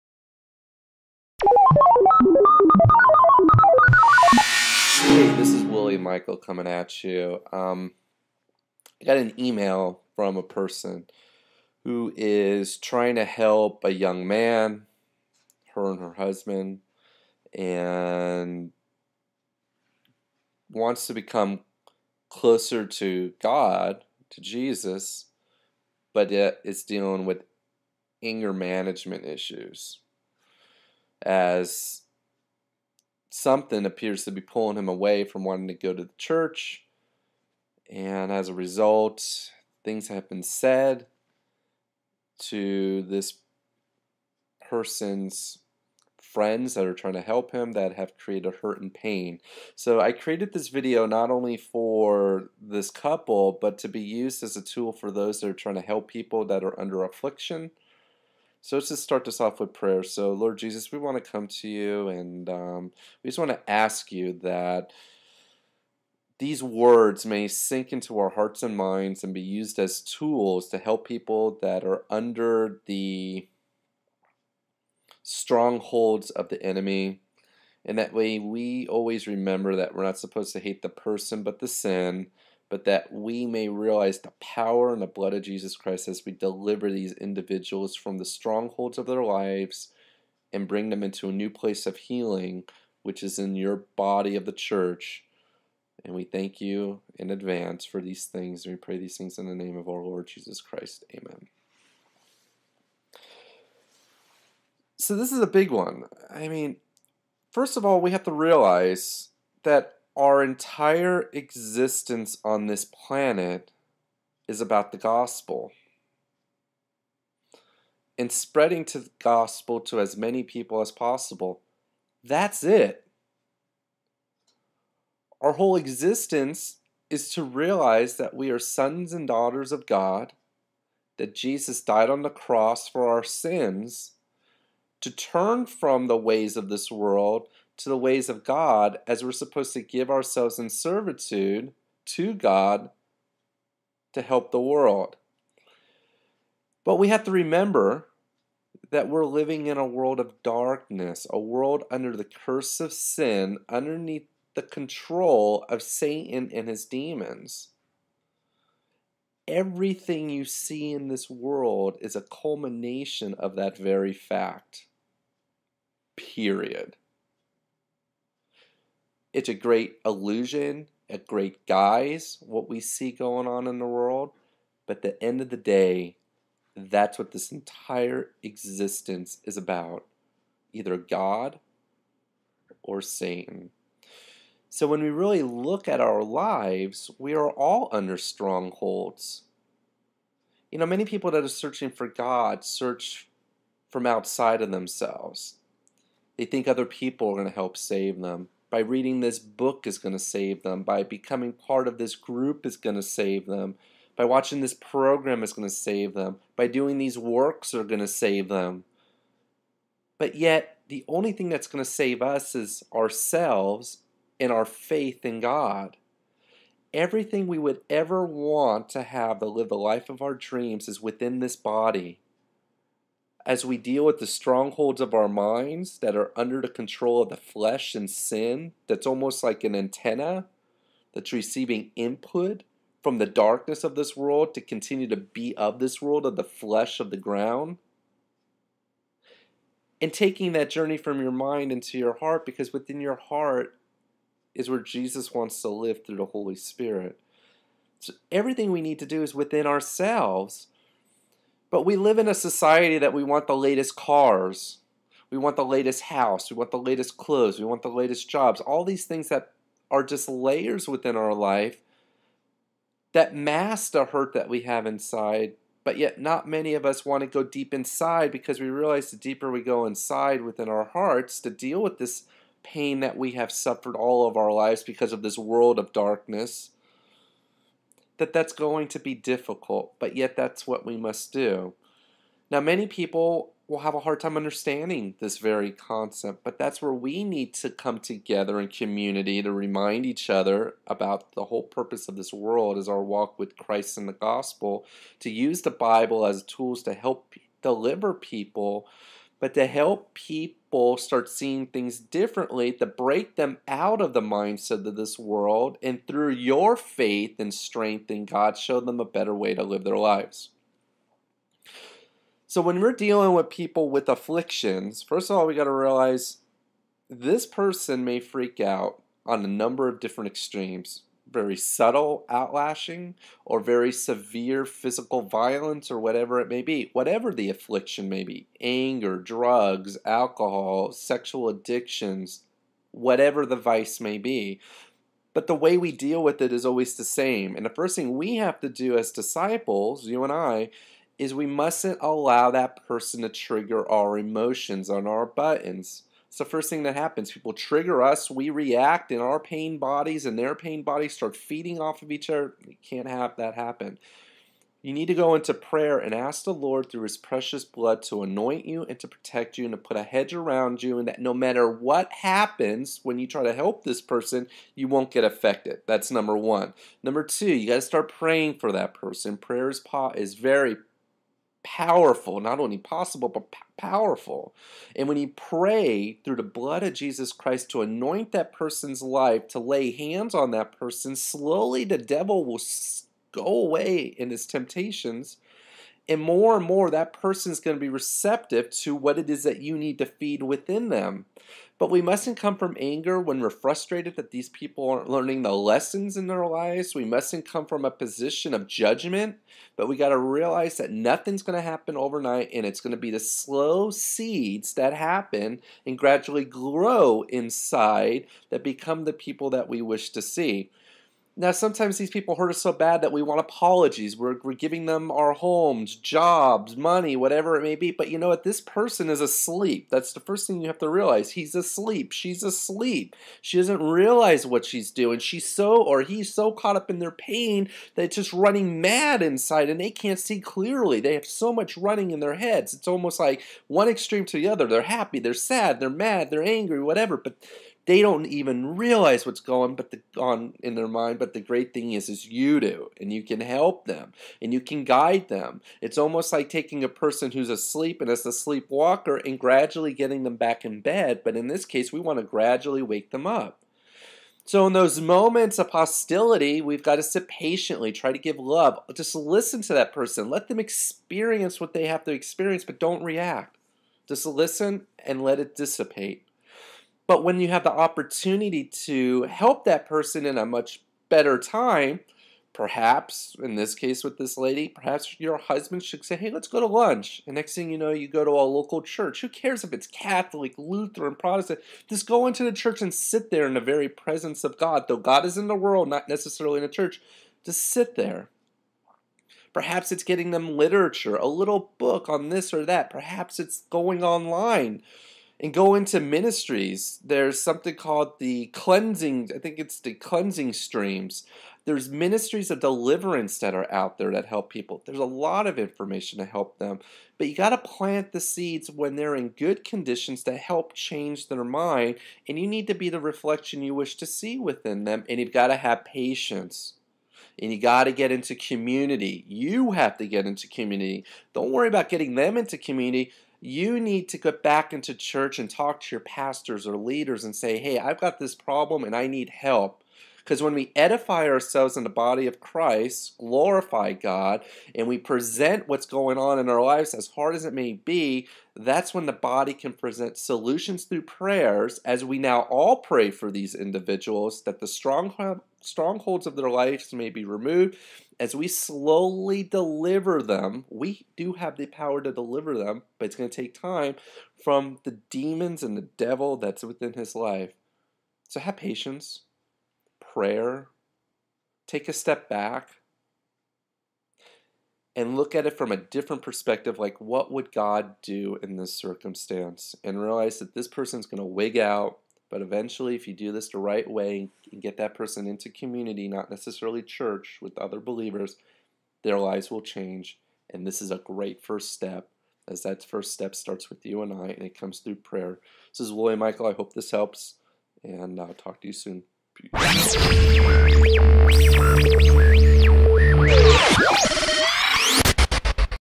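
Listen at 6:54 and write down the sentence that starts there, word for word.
We're, we're giving them our homes, jobs, money, whatever it may be.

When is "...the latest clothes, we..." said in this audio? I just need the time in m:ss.
4:16.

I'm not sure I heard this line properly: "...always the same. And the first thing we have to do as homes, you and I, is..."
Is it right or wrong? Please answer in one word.
wrong.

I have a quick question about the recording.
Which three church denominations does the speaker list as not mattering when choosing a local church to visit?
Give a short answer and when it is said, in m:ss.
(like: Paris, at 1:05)
Catholic, Lutheran, Protestant, at 7:59.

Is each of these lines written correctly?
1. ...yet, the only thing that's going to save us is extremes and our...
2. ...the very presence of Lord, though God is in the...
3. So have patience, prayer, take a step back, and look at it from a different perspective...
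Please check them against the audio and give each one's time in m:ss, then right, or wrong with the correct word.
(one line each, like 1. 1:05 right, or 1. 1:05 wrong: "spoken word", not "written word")
1. 3:30 wrong: "ourselves", not "extremes"
2. 8:03 wrong: "God", not "Lord"
3. 9:18 right.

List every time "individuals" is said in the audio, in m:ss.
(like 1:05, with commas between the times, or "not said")
1:27, 9:03.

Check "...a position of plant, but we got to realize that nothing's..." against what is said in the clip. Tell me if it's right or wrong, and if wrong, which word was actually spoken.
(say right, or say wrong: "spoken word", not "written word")
wrong: "judgment", not "plant".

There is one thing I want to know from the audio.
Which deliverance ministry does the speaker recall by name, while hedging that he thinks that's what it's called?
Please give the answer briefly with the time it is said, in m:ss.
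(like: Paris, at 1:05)
Cleansing Streams, at 8:19.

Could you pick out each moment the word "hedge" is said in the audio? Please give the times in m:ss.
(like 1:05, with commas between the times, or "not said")
6:00.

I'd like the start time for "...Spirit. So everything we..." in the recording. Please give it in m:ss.
4:06.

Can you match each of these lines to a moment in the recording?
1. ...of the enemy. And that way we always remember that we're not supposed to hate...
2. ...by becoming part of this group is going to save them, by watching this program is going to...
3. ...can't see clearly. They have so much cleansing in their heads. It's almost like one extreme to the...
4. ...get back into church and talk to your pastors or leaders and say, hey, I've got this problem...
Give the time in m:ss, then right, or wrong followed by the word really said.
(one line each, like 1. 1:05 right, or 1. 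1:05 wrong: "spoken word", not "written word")
1. 1:16 right
2. 3:20 right
3. 7:09 wrong: "running", not "cleansing"
4. 8:44 right.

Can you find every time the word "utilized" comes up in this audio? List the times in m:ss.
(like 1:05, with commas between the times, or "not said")
not said.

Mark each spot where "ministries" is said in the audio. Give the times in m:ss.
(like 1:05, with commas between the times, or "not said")
8:15, 8:21.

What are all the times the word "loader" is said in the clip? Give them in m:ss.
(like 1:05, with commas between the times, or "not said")
not said.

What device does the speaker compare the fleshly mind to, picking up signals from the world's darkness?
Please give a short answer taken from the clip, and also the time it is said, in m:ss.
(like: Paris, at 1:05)
An antenna, at 3:49.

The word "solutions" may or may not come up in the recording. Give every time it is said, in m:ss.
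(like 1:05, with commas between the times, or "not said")
9:00.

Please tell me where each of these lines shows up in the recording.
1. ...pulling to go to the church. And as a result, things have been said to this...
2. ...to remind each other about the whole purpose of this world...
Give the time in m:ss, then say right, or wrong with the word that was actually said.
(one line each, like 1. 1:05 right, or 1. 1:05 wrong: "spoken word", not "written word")
1. 0:35 wrong: "wanting", not "pulling"
2. 4:49 right.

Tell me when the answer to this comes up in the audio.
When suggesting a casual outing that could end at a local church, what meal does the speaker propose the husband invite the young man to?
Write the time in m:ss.
7:56.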